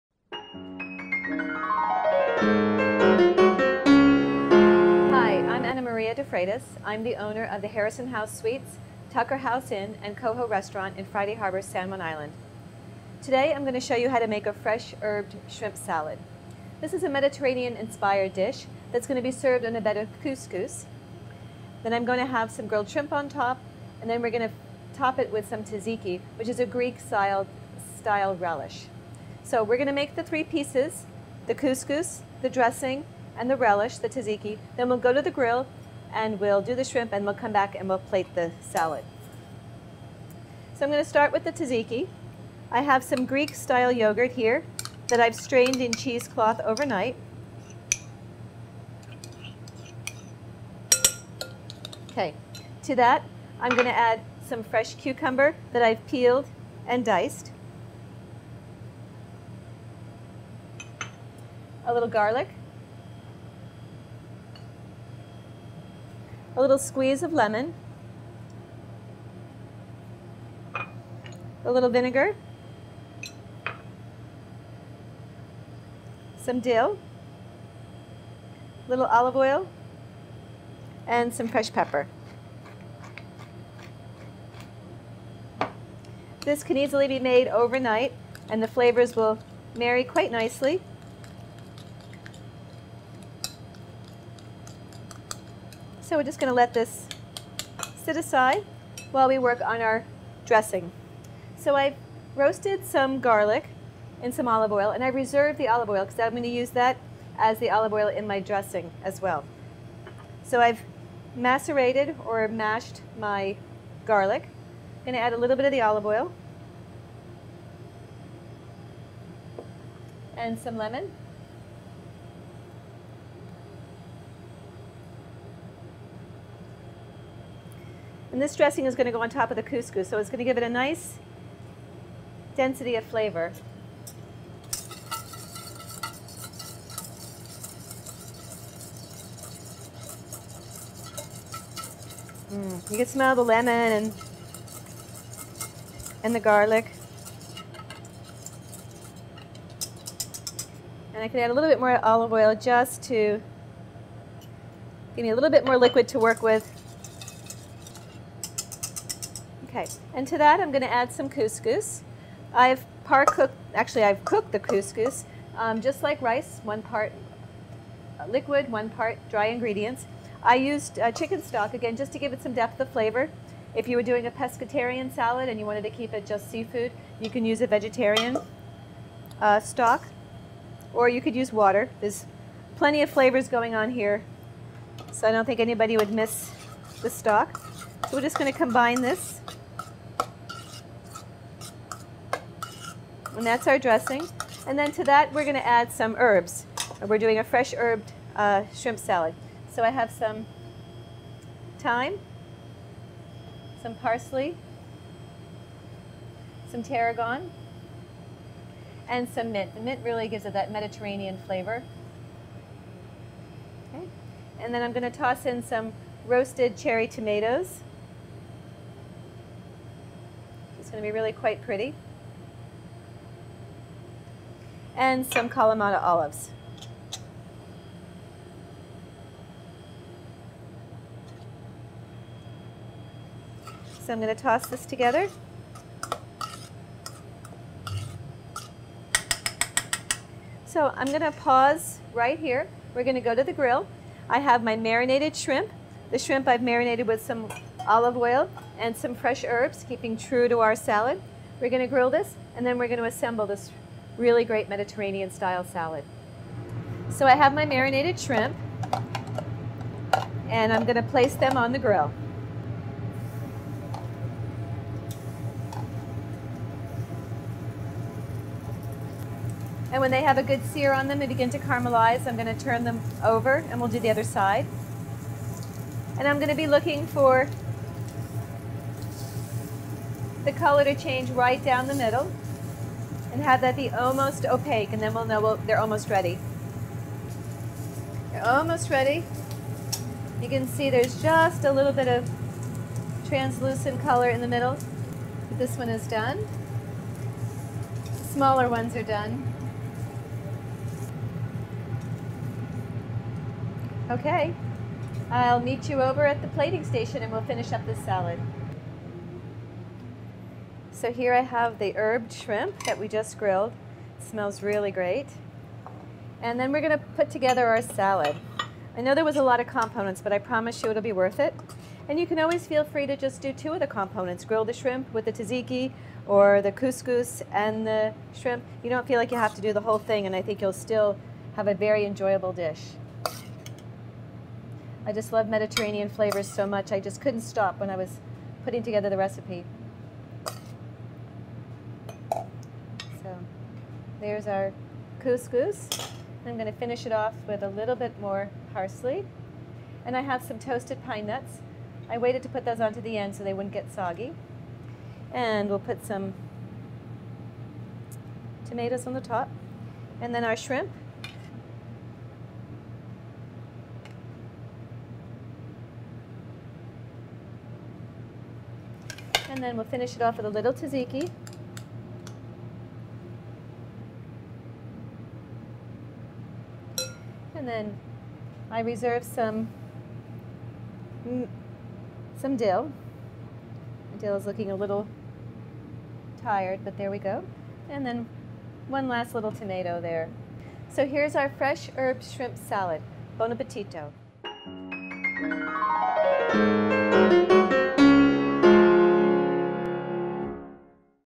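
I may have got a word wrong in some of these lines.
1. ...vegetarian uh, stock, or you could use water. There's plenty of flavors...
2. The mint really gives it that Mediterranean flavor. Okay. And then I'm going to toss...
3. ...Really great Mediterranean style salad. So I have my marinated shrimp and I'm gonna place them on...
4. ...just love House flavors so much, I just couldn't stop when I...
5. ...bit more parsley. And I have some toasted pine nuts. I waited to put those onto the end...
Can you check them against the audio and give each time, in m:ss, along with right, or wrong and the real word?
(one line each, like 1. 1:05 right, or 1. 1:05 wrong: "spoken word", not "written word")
1. 2:57 right
2. 3:29 right
3. 4:14 right
4. 5:35 wrong: "Mediterranean", not "House"
5. 5:47 right.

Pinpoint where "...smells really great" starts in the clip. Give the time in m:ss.
5:14.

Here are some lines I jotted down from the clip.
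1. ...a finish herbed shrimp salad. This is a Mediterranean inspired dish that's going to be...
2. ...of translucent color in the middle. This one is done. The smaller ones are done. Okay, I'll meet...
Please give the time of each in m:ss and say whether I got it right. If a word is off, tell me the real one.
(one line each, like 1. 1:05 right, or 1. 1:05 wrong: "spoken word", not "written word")
1. 0:14 wrong: "fresh", not "finish"
2. 4:52 right.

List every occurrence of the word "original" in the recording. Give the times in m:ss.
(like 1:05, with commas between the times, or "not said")
not said.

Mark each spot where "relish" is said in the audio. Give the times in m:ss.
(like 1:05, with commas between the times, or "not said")
0:28, 0:33.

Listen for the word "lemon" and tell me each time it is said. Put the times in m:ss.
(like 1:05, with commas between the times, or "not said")
1:07, 2:00, 2:23.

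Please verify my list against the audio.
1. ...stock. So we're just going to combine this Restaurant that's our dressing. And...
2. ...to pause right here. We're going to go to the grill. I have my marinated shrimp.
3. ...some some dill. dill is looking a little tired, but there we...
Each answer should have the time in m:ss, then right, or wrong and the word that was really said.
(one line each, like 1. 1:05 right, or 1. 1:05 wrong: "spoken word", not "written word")
1. 3:07 wrong: "And", not "Restaurant"
2. 4:01 right
3. 6:19 right.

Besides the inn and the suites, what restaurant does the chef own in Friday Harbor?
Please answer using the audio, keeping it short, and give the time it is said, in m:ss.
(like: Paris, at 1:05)
Coho Restaurant, at 0:10.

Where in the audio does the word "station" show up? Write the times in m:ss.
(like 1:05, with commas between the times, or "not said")
5:06.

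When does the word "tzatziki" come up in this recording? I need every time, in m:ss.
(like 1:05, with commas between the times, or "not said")
0:25, 0:34, 0:41, 5:25, 6:10.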